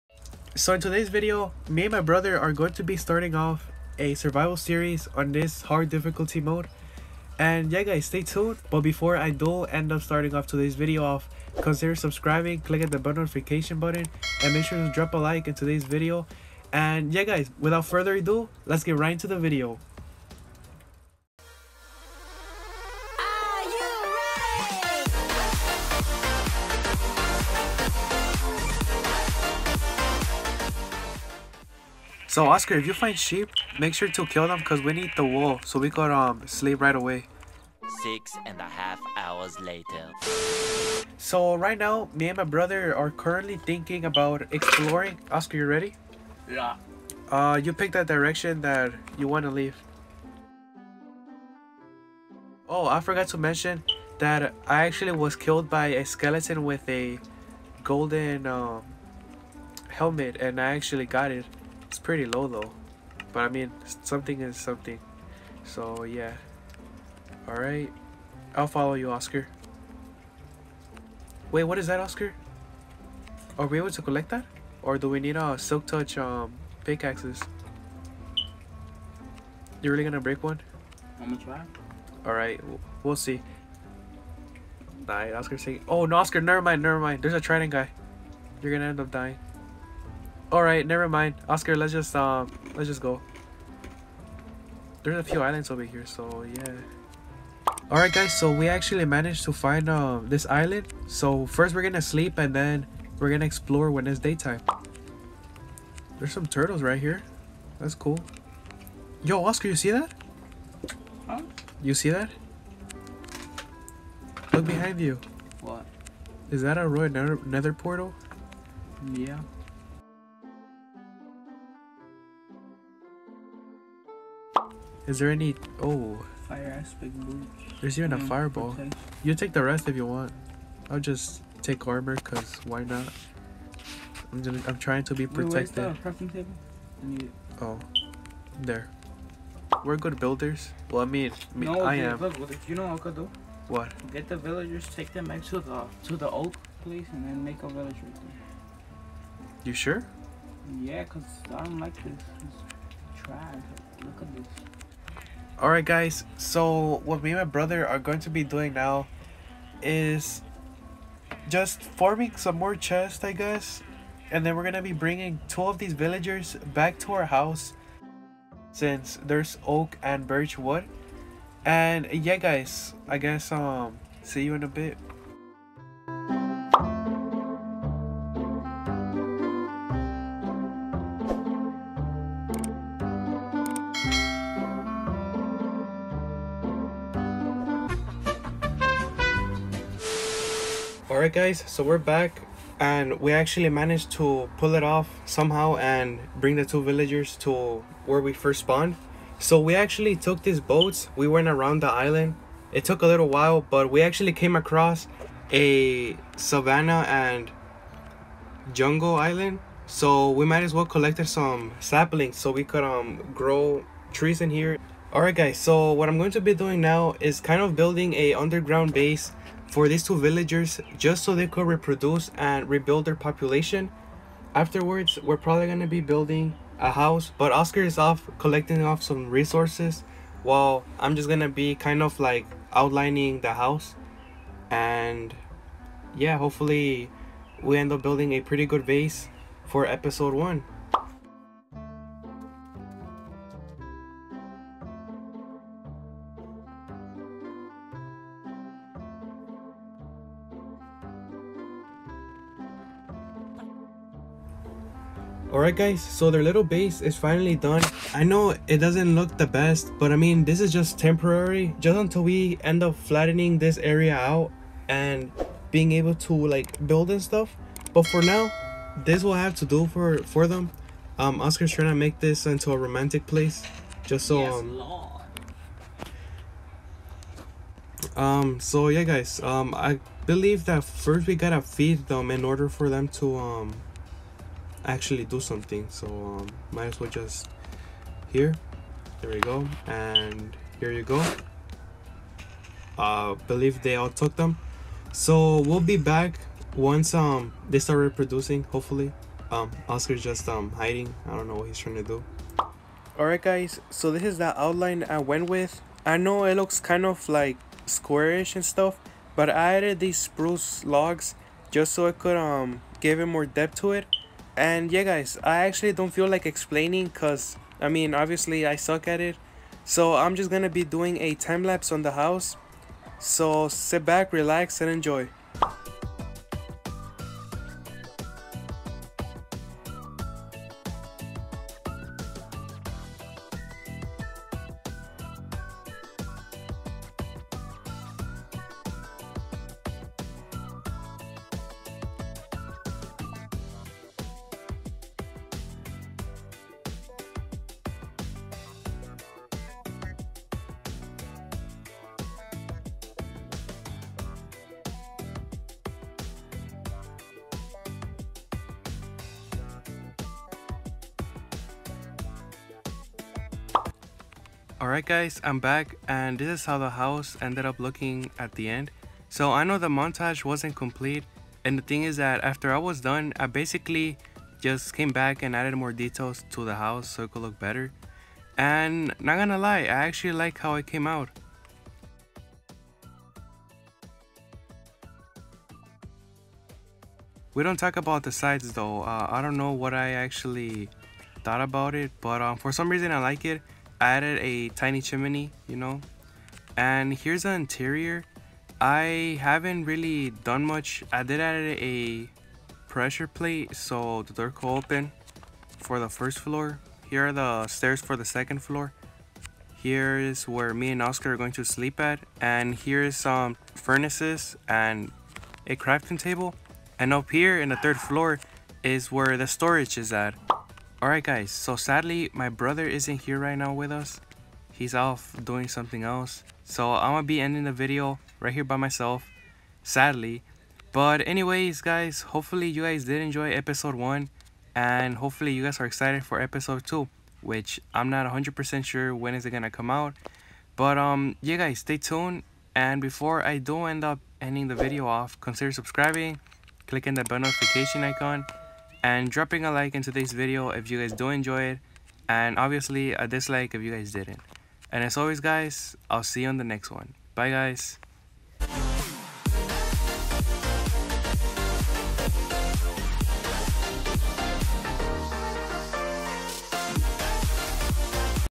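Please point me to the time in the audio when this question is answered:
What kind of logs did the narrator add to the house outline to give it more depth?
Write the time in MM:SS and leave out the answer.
05:10.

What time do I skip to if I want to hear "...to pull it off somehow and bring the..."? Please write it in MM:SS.
03:14.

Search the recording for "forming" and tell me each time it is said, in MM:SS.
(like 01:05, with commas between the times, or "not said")
02:41.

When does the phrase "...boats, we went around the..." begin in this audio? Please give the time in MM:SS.
03:20.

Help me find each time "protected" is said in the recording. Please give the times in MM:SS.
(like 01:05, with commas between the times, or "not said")
02:15.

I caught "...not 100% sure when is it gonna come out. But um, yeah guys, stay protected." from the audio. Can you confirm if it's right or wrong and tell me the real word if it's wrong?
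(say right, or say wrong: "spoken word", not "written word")
wrong: "tuned", not "protected".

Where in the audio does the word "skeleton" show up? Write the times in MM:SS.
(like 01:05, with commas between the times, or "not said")
00:56.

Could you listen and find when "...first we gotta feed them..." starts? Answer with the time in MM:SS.
04:40.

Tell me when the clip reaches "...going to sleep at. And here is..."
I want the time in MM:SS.
06:51.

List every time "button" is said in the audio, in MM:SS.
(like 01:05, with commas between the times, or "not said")
00:13.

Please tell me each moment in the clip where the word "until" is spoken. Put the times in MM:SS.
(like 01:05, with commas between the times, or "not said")
04:21.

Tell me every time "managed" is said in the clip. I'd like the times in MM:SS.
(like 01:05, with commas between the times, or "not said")
01:39, 03:13.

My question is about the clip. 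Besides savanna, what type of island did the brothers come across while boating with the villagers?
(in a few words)
Jungle.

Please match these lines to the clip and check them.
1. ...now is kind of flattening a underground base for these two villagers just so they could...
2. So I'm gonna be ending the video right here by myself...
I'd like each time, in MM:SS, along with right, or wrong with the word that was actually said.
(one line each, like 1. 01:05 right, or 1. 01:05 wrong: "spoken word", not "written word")
1. 03:36 wrong: "building", not "flattening"
2. 07:06 right.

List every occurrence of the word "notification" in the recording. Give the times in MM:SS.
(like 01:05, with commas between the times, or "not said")
00:13, 07:27.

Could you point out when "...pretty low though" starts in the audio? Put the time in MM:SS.
01:01.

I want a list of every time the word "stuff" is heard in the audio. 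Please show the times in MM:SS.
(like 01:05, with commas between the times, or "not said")
04:27, 05:08.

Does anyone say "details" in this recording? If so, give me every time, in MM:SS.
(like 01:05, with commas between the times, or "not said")
06:15.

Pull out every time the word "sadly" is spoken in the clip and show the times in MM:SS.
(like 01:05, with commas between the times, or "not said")
07:01, 07:09.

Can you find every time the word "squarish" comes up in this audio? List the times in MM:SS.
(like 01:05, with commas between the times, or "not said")
05:07.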